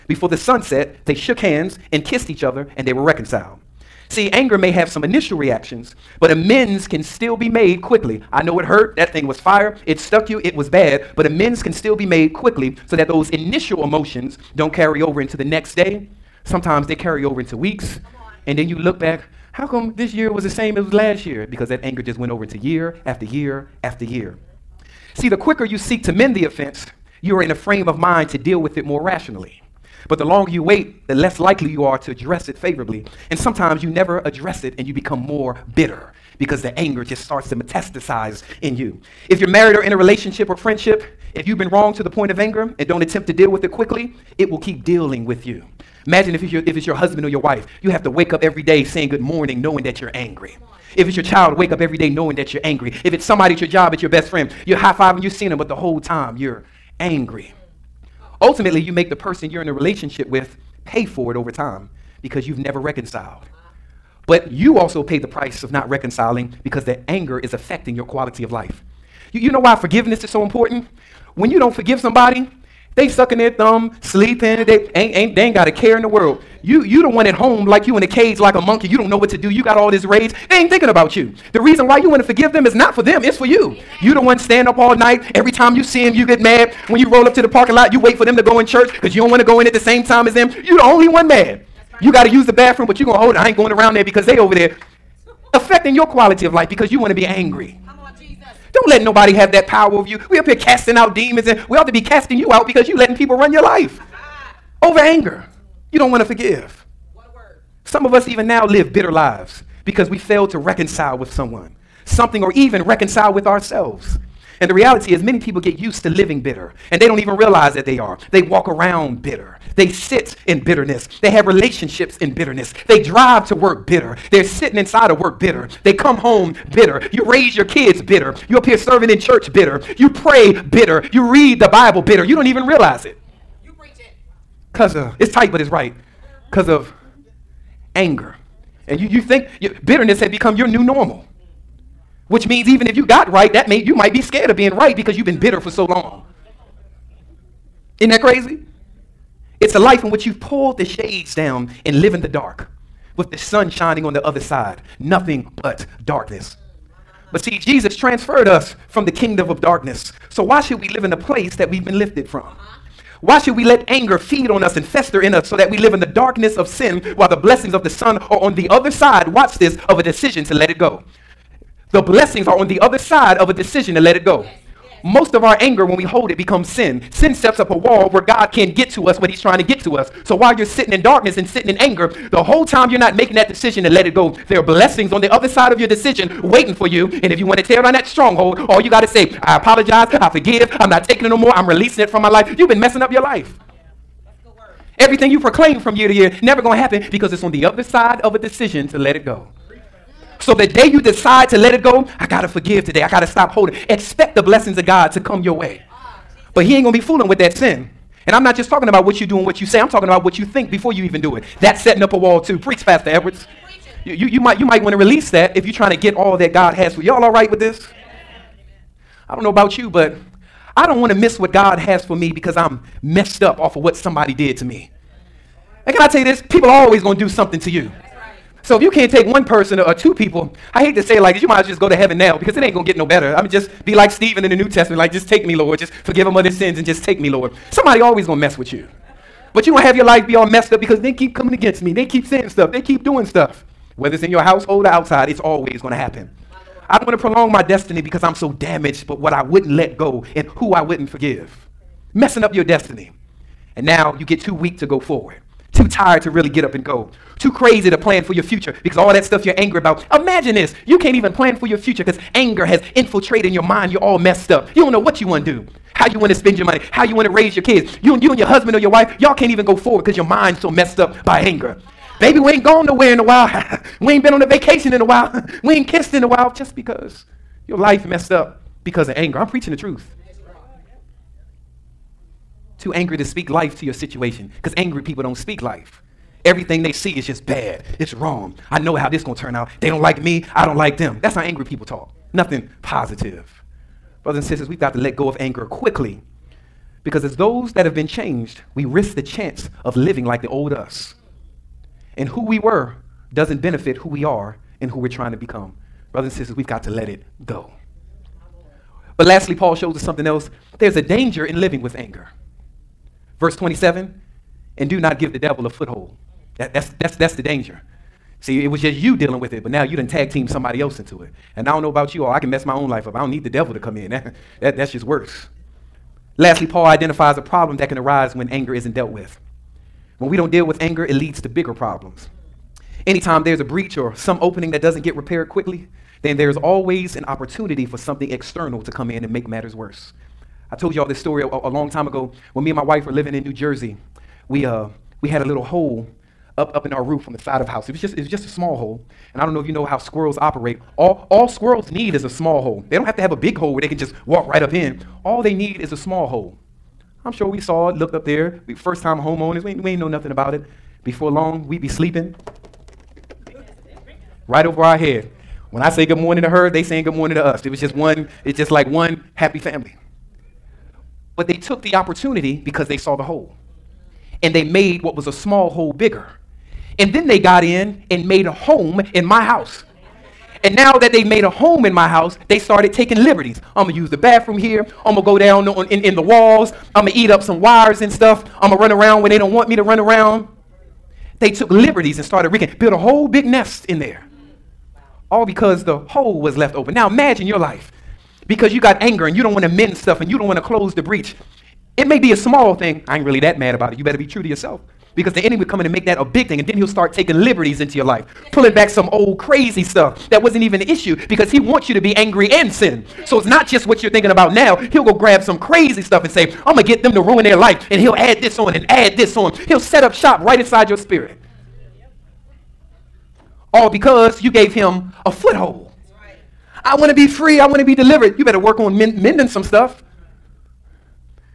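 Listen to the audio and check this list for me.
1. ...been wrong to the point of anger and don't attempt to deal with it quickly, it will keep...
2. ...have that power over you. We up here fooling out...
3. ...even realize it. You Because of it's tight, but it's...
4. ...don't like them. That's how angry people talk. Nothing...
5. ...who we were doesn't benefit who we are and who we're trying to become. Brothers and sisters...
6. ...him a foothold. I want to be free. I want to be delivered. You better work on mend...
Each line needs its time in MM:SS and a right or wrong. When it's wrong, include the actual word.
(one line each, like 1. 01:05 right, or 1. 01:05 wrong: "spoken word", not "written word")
1. 00:41 right
2. 01:39 wrong: "casting", not "fooling"
3. 02:12 right
4. 04:50 right
5. 05:02 right
6. 07:04 right.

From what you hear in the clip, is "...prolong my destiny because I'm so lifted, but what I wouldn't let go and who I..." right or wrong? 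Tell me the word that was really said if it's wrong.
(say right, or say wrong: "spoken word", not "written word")
wrong: "damaged", not "lifted".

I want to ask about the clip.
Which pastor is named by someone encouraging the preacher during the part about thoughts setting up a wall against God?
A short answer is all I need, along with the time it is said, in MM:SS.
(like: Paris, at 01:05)
Pastor Edwards, at 03:32.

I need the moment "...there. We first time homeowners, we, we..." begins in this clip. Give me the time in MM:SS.
05:58.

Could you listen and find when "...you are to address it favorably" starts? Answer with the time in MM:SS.
00:31.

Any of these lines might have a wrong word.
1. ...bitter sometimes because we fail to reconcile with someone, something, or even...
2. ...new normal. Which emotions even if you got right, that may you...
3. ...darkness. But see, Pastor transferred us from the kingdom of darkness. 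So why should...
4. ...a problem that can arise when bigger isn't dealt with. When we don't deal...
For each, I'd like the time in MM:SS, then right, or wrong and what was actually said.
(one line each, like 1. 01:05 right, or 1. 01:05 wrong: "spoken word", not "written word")
1. 01:48 wrong: "lives", not "sometimes"
2. 02:20 wrong: "means", not "emotions"
3. 02:36 wrong: "Jesus", not "Pastor"
4. 05:27 wrong: "anger", not "bigger".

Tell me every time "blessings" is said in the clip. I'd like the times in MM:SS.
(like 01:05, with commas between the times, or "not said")
02:47, 02:51, 03:04, 03:24.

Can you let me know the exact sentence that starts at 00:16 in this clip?
Sometimes they carry over into weeks, and then you look back, how come this year was the same as last year?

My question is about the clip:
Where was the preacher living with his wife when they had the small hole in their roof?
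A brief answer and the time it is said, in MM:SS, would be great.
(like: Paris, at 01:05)
New Jersey, at 05:43.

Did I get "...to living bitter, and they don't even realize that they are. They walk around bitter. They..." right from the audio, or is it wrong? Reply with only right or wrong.
right.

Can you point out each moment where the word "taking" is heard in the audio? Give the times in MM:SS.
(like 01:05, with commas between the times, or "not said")
03:11, 06:22, 06:47.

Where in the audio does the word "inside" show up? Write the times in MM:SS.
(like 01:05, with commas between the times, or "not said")
02:04, 07:00.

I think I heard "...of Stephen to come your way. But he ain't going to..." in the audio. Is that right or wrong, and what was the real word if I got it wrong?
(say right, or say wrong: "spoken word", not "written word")
wrong: "God", not "Stephen".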